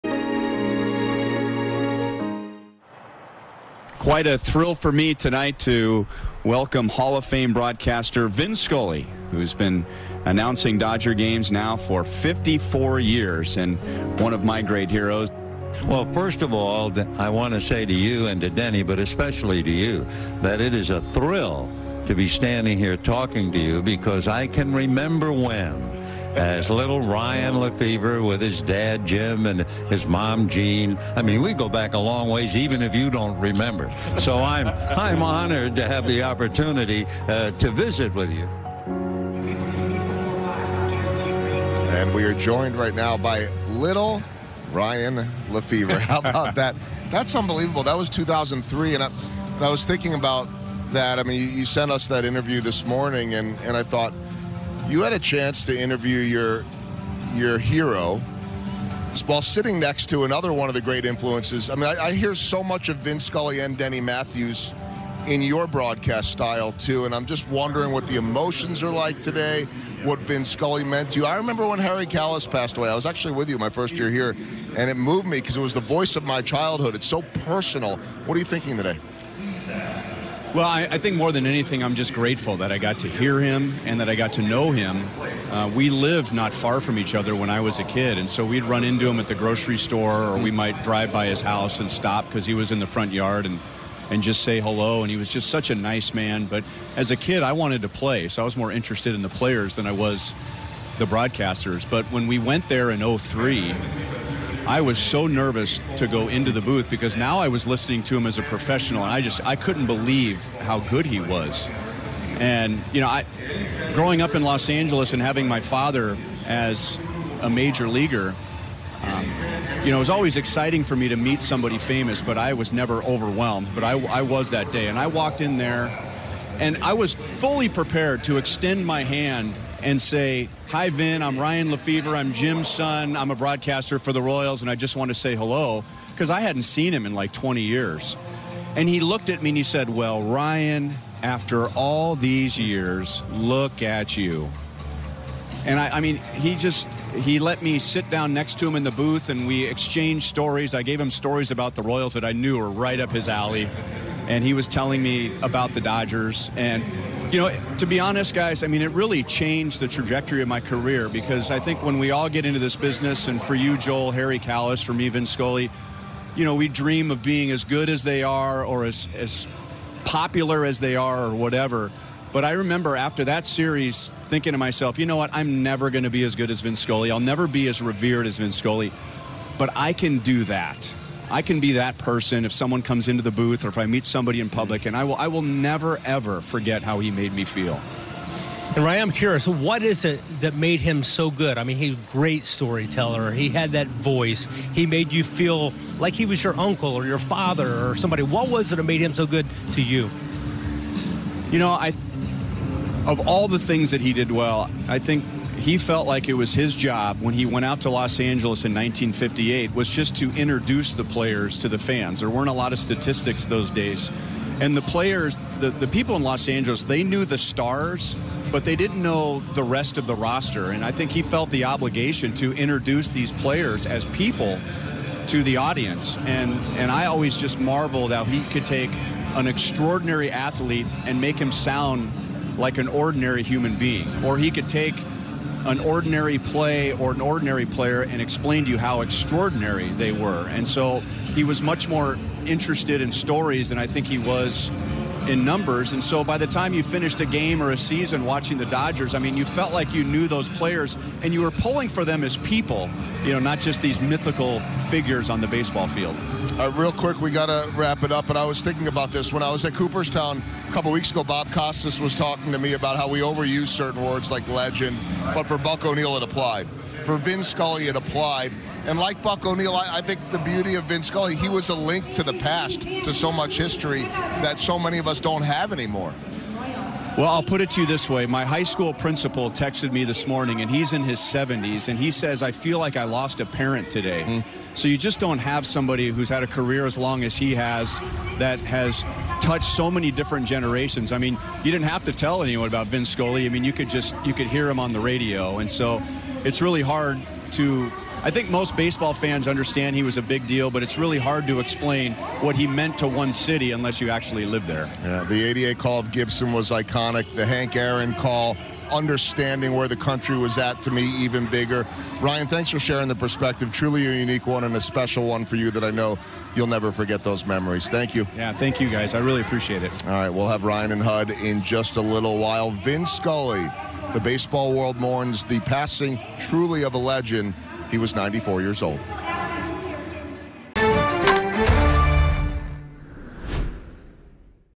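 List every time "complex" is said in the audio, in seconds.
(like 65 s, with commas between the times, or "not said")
not said.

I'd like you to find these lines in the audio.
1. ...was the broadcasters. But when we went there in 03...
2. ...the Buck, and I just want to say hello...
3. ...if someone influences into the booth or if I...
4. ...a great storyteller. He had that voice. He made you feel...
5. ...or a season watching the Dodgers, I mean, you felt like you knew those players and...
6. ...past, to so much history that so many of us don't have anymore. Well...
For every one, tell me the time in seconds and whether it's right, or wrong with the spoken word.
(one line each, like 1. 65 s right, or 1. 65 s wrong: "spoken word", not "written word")
1. 99 s right
2. 134 s wrong: "Royals", not "Buck"
3. 182 s wrong: "comes", not "influences"
4. 191 s right
5. 247 s right
6. 272 s right.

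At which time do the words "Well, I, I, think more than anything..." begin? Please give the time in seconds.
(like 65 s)
80 s.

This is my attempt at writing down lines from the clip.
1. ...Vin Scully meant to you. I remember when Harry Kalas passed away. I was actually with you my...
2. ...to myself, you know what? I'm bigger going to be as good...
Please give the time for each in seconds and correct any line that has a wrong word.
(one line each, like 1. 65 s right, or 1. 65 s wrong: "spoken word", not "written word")
1. 70 s right
2. 174 s wrong: "never", not "bigger".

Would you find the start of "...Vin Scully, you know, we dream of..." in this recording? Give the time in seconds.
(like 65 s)
165 s.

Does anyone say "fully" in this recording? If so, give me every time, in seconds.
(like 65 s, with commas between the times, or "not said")
127 s.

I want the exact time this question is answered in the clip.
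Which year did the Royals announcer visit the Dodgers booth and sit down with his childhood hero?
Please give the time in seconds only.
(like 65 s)
48 s.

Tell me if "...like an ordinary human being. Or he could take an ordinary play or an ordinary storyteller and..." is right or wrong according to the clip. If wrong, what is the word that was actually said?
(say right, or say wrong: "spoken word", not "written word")
wrong: "player", not "storyteller".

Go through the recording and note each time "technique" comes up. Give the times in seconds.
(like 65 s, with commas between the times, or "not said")
not said.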